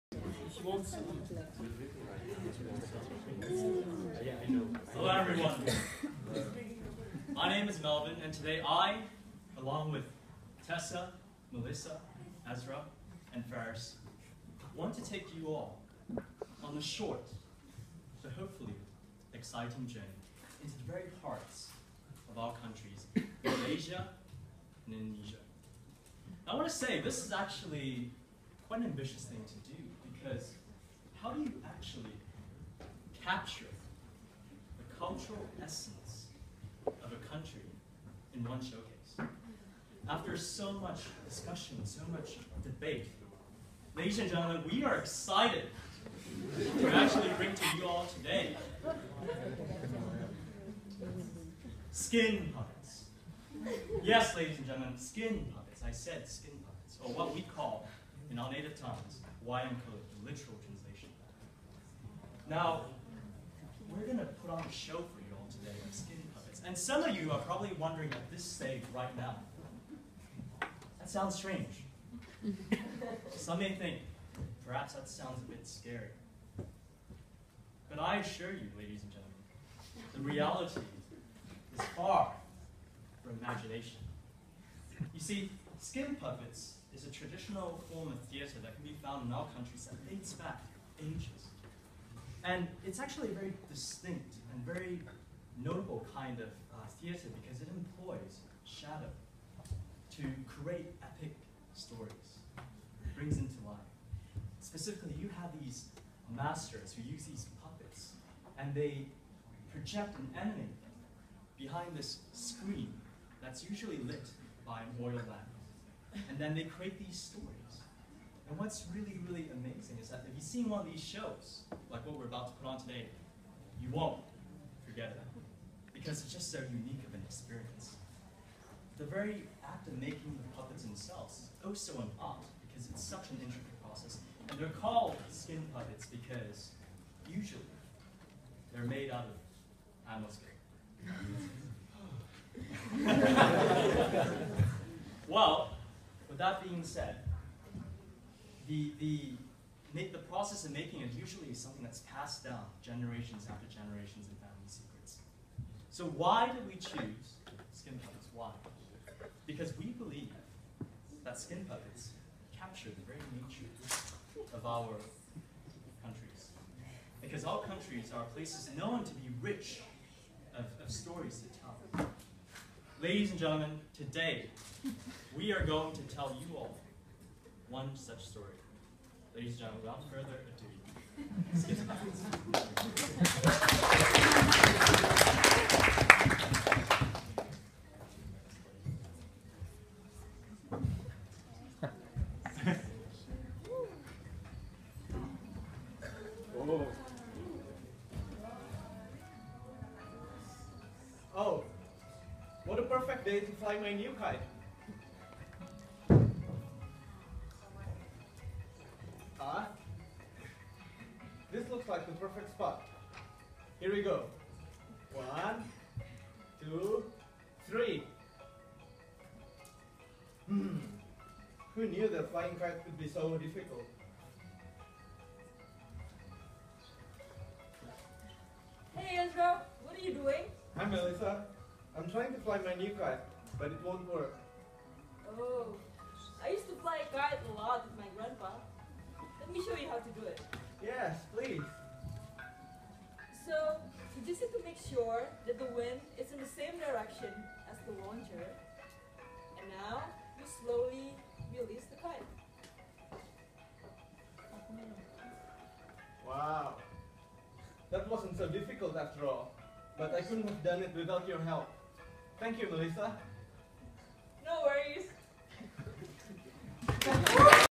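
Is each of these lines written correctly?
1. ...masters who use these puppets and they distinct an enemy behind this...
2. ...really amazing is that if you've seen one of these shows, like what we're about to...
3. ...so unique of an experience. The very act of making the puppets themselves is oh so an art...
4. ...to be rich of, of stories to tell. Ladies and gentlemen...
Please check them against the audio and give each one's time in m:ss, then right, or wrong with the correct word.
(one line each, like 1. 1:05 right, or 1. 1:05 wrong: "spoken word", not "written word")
1. 1:46 wrong: "project", not "distinct"
2. 1:59 right
3. 2:06 right
4. 2:49 right.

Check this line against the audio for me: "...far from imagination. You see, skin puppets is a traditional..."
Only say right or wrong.
right.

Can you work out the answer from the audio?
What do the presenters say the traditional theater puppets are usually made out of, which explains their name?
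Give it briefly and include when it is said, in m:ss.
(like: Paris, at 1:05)
animal skin, at 2:20.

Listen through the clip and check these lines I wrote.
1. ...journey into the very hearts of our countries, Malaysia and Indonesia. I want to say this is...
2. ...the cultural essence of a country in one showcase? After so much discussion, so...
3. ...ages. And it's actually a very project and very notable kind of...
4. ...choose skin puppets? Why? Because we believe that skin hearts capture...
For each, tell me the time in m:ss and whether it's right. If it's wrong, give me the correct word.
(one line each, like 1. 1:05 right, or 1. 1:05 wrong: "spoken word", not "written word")
1. 0:19 right
2. 0:34 right
3. 1:30 wrong: "distinct", not "project"
4. 2:36 wrong: "puppets", not "hearts".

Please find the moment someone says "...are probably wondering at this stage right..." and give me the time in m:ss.
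1:07.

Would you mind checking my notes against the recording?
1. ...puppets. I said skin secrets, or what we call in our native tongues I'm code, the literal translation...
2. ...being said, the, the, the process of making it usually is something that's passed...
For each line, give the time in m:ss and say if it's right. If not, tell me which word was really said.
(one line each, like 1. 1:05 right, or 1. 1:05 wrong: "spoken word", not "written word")
1. 0:55 wrong: "puppets", not "secrets"
2. 2:26 right.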